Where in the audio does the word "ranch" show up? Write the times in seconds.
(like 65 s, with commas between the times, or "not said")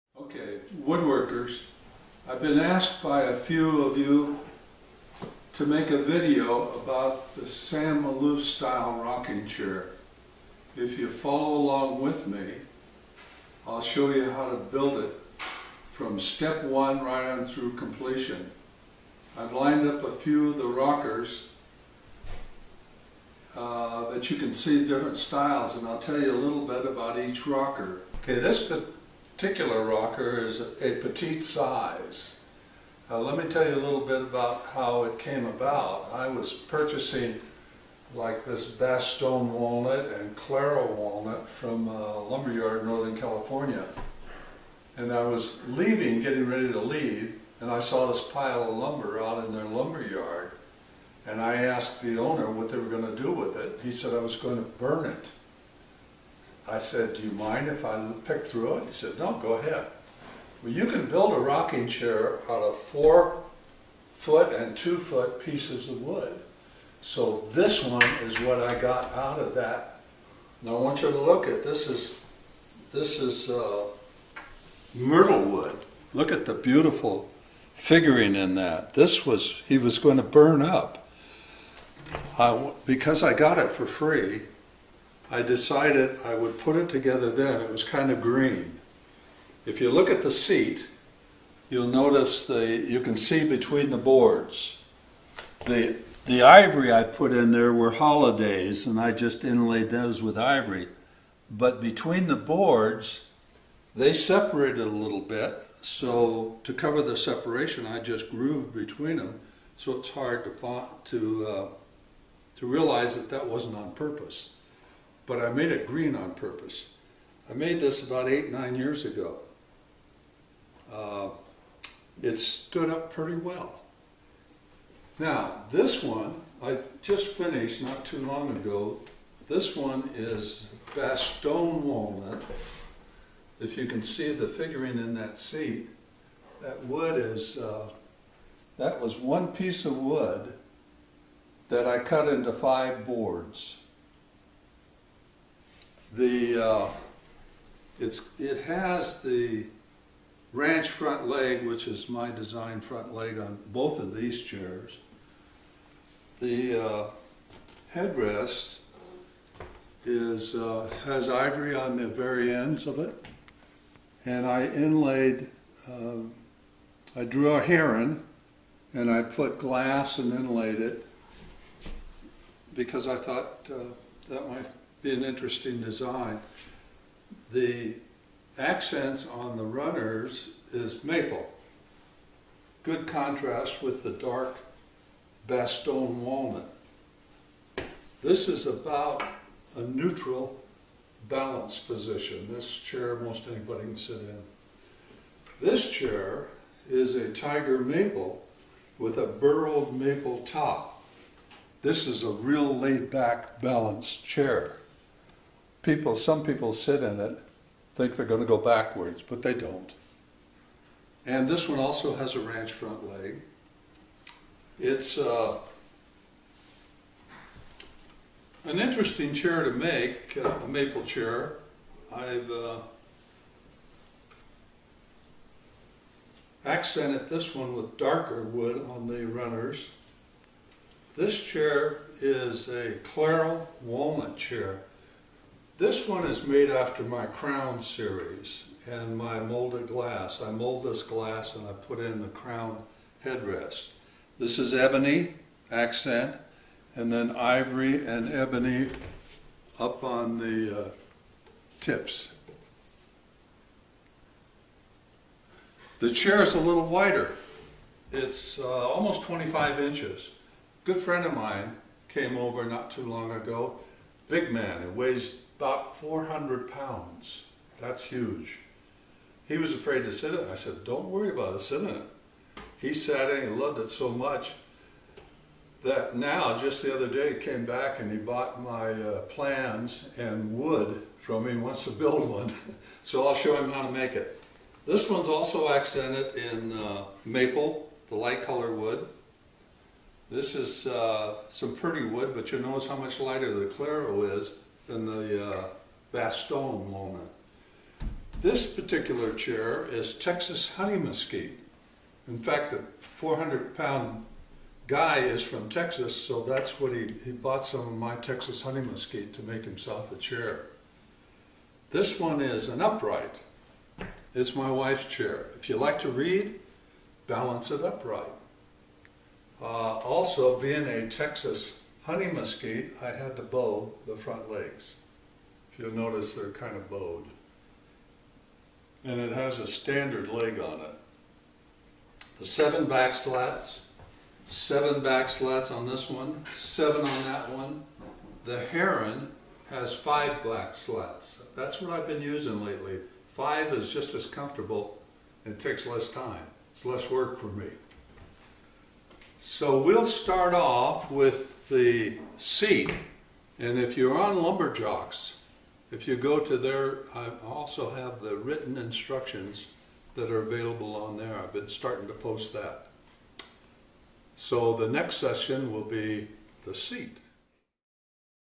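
150 s, 212 s.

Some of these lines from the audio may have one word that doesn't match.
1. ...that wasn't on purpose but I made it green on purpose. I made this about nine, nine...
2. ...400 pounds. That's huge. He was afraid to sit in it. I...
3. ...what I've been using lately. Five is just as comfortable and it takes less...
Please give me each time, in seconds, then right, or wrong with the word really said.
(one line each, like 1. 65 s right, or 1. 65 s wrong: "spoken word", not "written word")
1. 113 s wrong: "eight", not "nine"
2. 265 s right
3. 341 s right.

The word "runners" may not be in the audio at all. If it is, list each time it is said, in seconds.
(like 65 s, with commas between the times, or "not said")
179 s, 229 s.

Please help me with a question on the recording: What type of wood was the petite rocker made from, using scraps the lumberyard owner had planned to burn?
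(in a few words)
myrtle wood.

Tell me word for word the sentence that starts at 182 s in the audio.
Good contrast with the dark Bastogne walnut.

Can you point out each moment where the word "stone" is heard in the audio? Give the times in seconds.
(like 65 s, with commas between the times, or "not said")
131 s.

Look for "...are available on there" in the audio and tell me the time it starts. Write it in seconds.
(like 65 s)
360 s.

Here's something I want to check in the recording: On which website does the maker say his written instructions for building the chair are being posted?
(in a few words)
Lumberjocks.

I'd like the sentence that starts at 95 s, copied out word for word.
The the ivory I put in there were holidays, and I just inlaid those with ivory.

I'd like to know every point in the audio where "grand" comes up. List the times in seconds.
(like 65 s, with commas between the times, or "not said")
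not said.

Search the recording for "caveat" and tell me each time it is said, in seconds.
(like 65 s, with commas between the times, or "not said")
not said.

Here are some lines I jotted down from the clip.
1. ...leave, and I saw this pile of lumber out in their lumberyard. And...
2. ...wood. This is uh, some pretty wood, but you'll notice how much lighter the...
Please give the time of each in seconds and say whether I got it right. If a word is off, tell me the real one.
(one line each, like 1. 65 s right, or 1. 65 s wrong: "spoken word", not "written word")
1. 46 s right
2. 288 s right.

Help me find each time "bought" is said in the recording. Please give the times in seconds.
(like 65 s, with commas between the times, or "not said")
278 s, 307 s.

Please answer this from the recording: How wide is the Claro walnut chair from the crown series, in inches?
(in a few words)
25.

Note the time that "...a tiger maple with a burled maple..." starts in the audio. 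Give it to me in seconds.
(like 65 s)
197 s.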